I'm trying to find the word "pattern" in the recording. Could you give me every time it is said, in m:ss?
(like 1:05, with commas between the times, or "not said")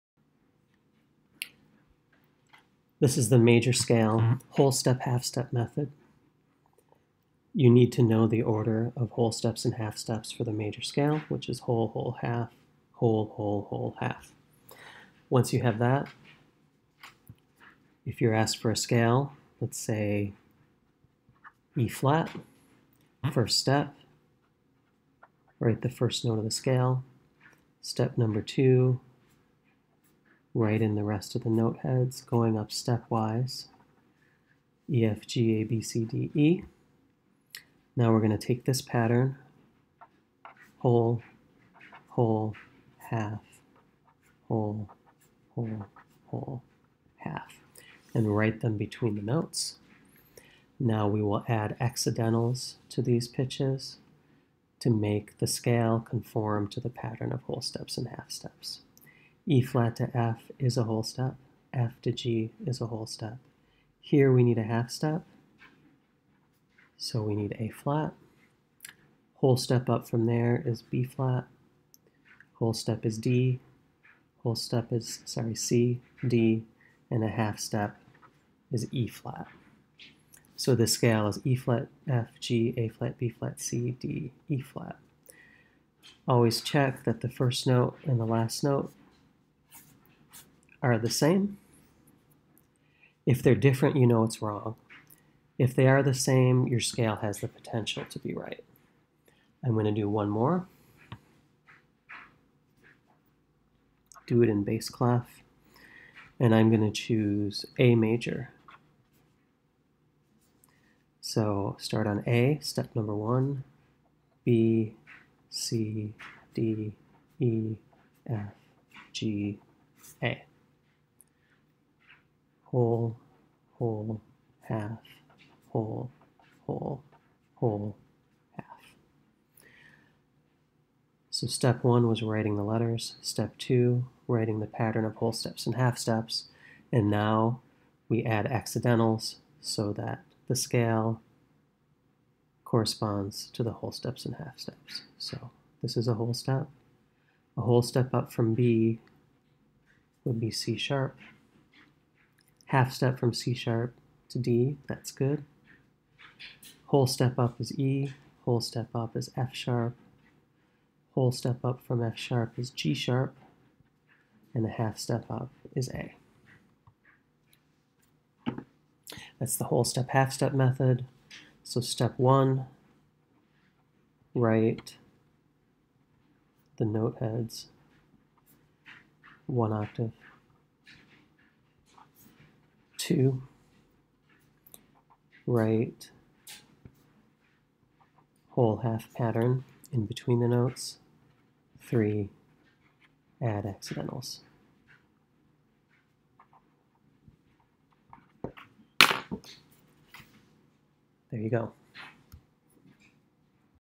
0:38, 0:56, 2:14, 3:09.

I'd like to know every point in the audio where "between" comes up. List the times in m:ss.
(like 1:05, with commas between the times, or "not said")
0:48, 3:10.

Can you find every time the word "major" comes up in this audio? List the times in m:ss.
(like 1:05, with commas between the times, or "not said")
0:03, 0:10, 1:47.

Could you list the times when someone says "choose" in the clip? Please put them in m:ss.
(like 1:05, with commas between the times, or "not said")
1:46.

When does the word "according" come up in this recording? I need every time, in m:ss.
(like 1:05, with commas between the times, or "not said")
not said.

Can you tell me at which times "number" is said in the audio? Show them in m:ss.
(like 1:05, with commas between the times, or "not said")
0:28, 1:52.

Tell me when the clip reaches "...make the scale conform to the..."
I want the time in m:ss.
0:54.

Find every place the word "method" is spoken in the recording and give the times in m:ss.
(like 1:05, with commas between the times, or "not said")
0:05, 2:50.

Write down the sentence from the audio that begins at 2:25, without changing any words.
So this is a whole step.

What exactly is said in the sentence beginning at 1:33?
If they're different, you know it's wrong.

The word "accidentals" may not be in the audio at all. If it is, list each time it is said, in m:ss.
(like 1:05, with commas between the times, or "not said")
0:51, 2:18, 3:13.